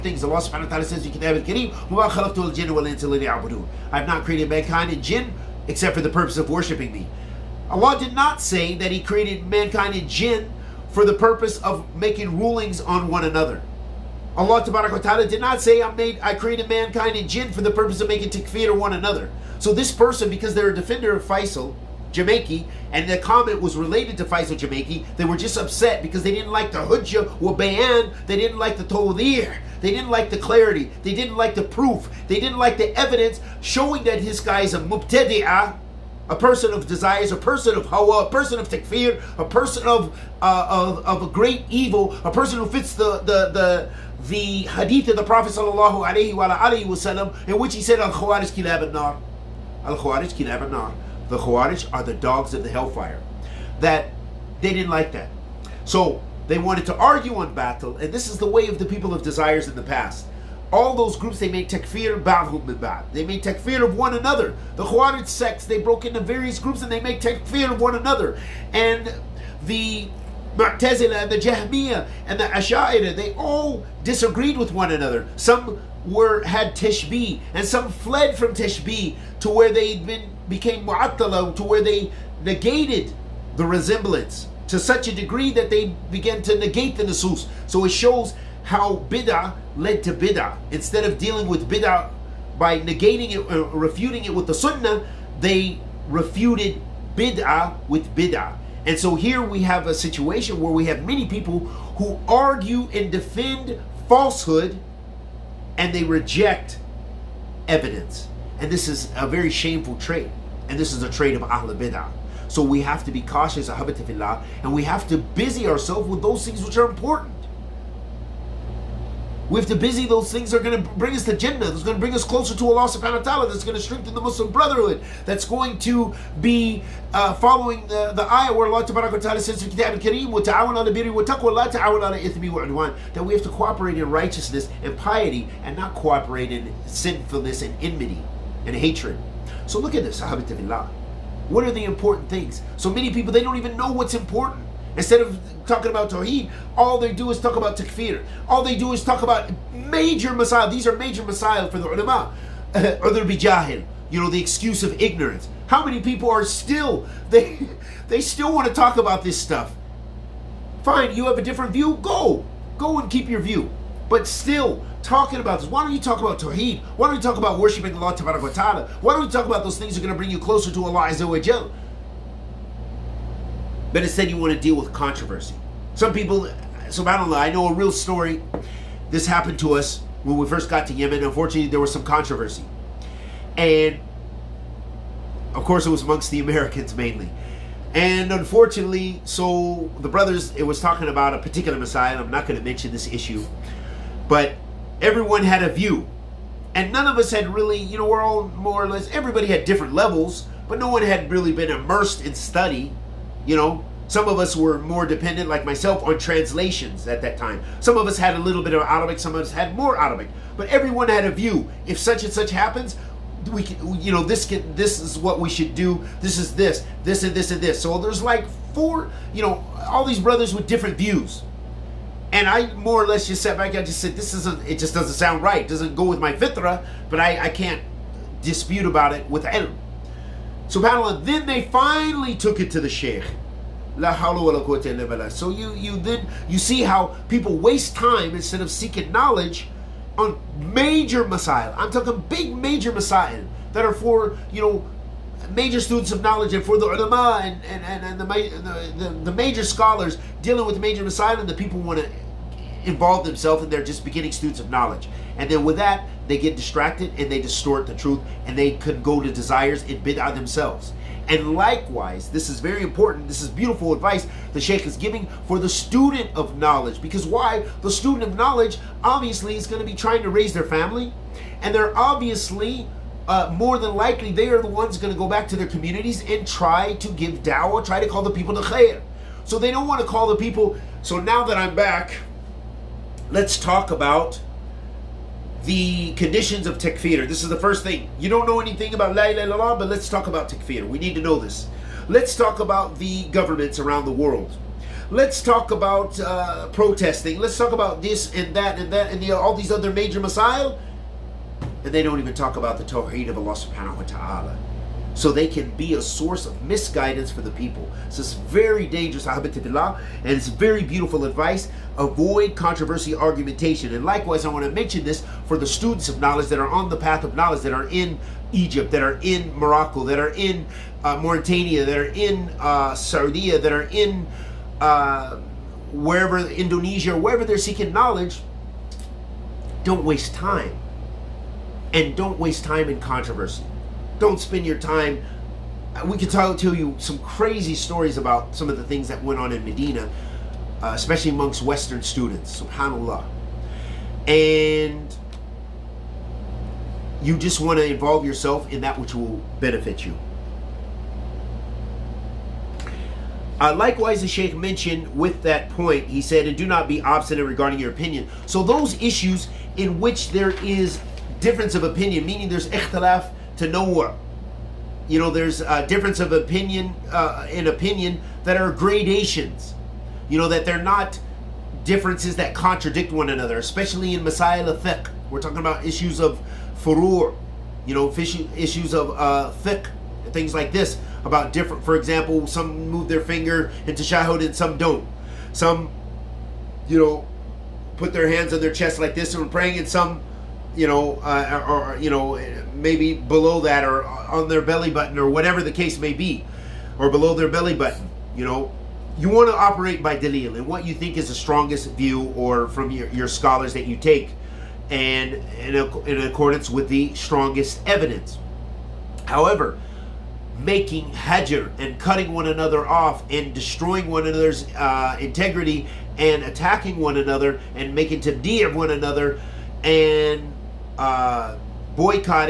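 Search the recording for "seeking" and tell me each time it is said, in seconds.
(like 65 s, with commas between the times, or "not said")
238 s, 327 s.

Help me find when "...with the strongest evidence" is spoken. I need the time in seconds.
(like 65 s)
406 s.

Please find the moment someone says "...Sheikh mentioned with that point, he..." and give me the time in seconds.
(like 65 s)
354 s.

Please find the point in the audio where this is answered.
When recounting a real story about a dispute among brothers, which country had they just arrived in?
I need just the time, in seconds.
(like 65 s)
180 s.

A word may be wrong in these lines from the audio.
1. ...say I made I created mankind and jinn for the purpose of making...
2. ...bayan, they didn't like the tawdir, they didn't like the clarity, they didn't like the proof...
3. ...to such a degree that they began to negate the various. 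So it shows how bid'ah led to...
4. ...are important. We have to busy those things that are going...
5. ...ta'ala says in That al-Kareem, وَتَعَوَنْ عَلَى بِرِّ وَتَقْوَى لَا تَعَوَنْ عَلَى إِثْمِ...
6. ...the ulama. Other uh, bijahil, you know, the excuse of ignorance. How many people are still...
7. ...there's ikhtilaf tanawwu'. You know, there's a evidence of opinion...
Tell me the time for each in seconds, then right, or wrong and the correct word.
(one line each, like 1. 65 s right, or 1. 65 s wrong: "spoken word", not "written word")
1. 15 s right
2. 27 s right
3. 84 s wrong: "nusus", not "various"
4. 116 s right
5. 129 s wrong: "Kitab", not "That"
6. 151 s right
7. 362 s wrong: "difference", not "evidence".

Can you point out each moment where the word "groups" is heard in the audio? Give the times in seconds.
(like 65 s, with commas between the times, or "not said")
61 s, 66 s.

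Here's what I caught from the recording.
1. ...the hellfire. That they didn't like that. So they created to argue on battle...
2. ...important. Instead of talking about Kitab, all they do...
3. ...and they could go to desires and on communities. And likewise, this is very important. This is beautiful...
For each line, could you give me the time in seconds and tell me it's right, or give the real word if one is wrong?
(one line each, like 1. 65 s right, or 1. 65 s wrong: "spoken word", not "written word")
1. 52 s wrong: "wanted", not "created"
2. 144 s wrong: "Tawheed", not "Kitab"
3. 258 s wrong: "themselves", not "communities".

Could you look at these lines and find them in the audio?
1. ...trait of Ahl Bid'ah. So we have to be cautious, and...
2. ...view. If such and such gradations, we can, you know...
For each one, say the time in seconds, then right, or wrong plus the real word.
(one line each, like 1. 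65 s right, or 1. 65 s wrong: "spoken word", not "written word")
1. 111 s right
2. 211 s wrong: "happens", not "gradations".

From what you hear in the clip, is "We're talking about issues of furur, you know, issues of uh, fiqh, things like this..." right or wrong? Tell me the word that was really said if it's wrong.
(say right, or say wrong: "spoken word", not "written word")
right.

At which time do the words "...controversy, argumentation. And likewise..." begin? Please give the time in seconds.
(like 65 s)
312 s.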